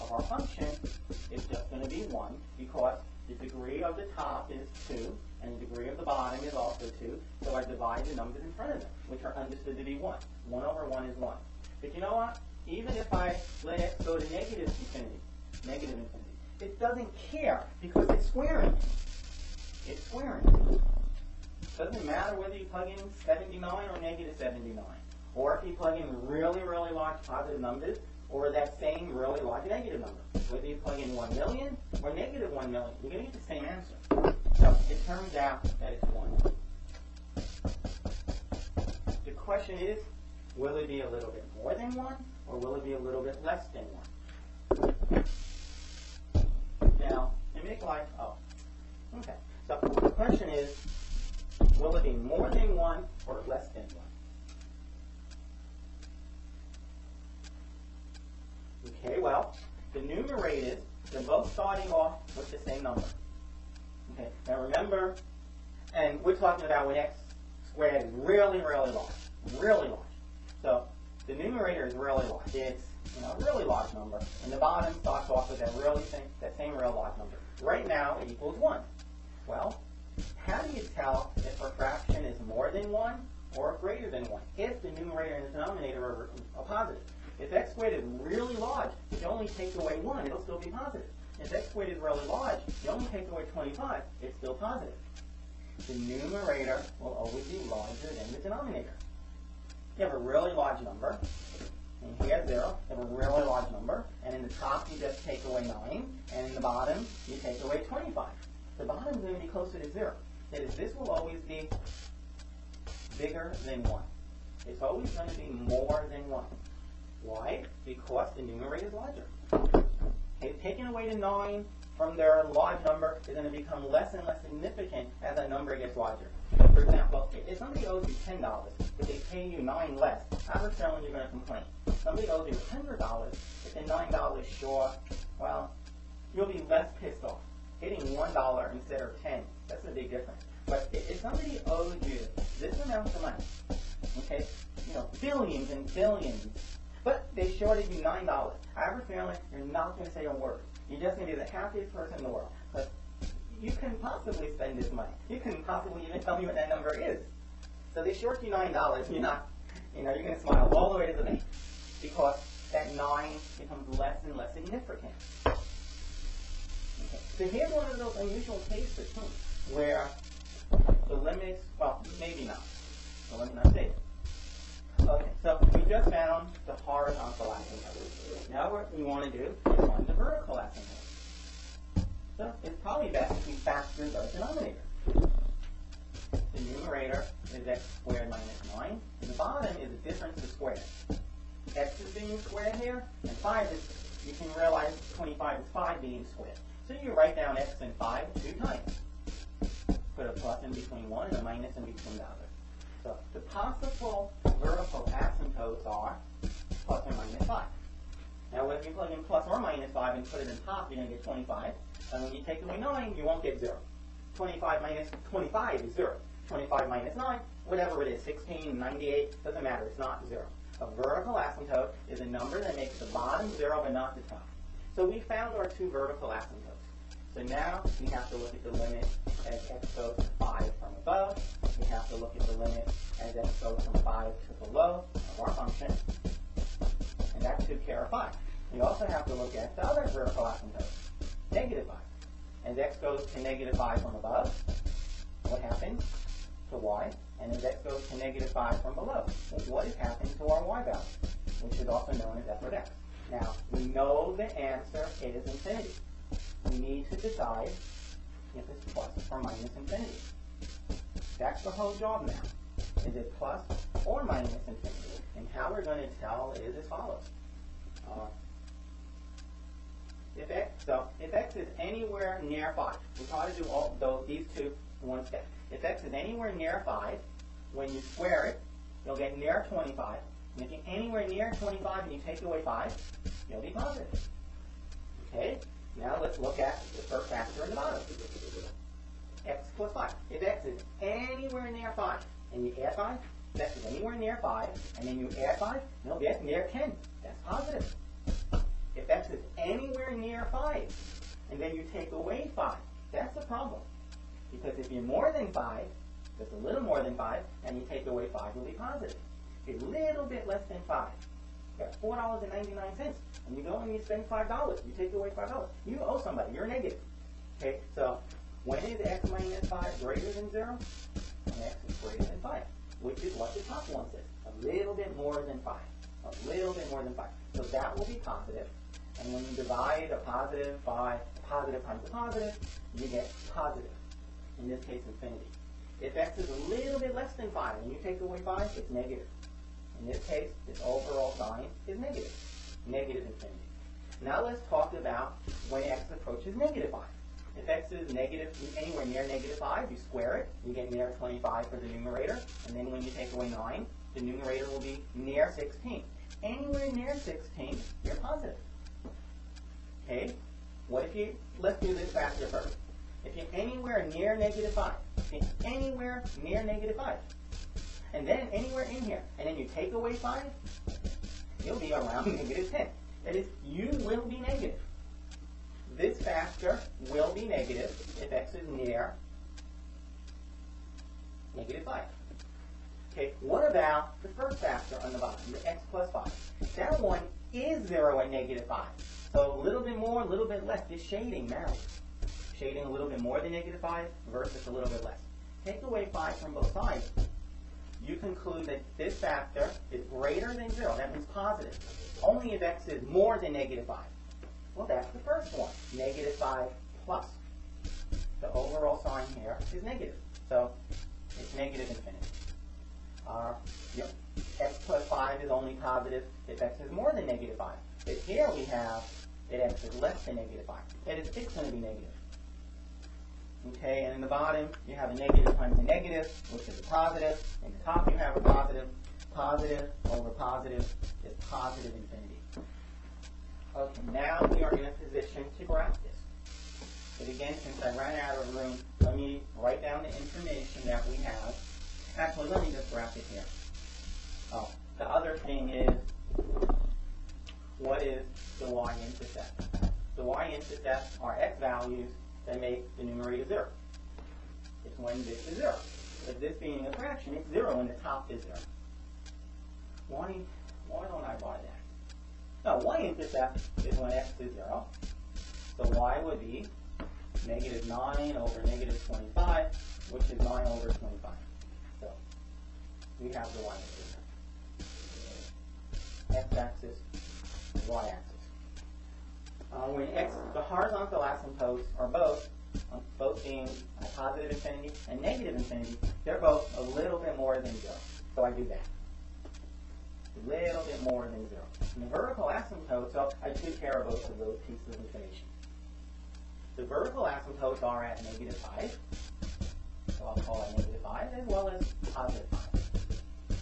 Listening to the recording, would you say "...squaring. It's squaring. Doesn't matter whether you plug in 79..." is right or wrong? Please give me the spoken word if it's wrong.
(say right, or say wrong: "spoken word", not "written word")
right.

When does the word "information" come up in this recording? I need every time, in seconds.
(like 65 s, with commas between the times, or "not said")
440 s, 495 s.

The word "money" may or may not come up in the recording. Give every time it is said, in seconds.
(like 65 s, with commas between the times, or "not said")
143 s, 154 s.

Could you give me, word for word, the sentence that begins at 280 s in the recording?
And if you're anywhere near 25 and you take away 5, you'll be positive.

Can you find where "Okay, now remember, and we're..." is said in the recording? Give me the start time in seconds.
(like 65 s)
64 s.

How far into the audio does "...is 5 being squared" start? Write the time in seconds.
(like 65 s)
195 s.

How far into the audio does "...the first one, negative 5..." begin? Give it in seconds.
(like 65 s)
405 s.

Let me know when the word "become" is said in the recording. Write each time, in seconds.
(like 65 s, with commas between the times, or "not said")
123 s, 163 s.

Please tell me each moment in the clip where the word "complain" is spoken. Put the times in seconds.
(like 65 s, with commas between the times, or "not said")
131 s.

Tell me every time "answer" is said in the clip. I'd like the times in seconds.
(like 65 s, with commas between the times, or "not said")
33 s, 254 s.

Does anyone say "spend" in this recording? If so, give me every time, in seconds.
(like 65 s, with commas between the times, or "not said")
154 s, 314 s.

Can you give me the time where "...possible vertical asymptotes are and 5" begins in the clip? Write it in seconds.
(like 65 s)
203 s.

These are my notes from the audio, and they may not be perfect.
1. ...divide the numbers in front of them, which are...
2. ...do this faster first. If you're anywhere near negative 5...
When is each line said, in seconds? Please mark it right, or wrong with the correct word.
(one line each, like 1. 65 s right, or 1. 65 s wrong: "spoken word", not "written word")
1. 7 s right
2. 361 s right.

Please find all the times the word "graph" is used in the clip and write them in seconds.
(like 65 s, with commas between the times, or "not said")
435 s, 442 s.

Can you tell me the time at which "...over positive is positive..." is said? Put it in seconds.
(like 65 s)
430 s.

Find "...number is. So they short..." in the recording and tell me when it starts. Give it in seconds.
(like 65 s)
156 s.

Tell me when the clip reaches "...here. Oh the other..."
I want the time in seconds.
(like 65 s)
443 s.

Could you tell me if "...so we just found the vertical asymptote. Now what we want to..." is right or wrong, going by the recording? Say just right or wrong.
wrong.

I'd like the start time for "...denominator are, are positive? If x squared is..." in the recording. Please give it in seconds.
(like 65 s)
85 s.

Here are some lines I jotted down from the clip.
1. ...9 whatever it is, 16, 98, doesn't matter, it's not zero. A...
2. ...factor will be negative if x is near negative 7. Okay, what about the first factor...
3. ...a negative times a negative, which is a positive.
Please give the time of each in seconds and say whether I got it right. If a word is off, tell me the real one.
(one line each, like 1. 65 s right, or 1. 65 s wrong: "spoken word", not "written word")
1. 217 s right
2. 376 s wrong: "5", not "7"
3. 425 s right.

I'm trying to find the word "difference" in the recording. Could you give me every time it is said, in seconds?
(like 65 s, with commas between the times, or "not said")
140 s, 190 s.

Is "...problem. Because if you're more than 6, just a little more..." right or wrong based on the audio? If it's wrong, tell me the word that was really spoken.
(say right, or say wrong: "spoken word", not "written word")
wrong: "5", not "6".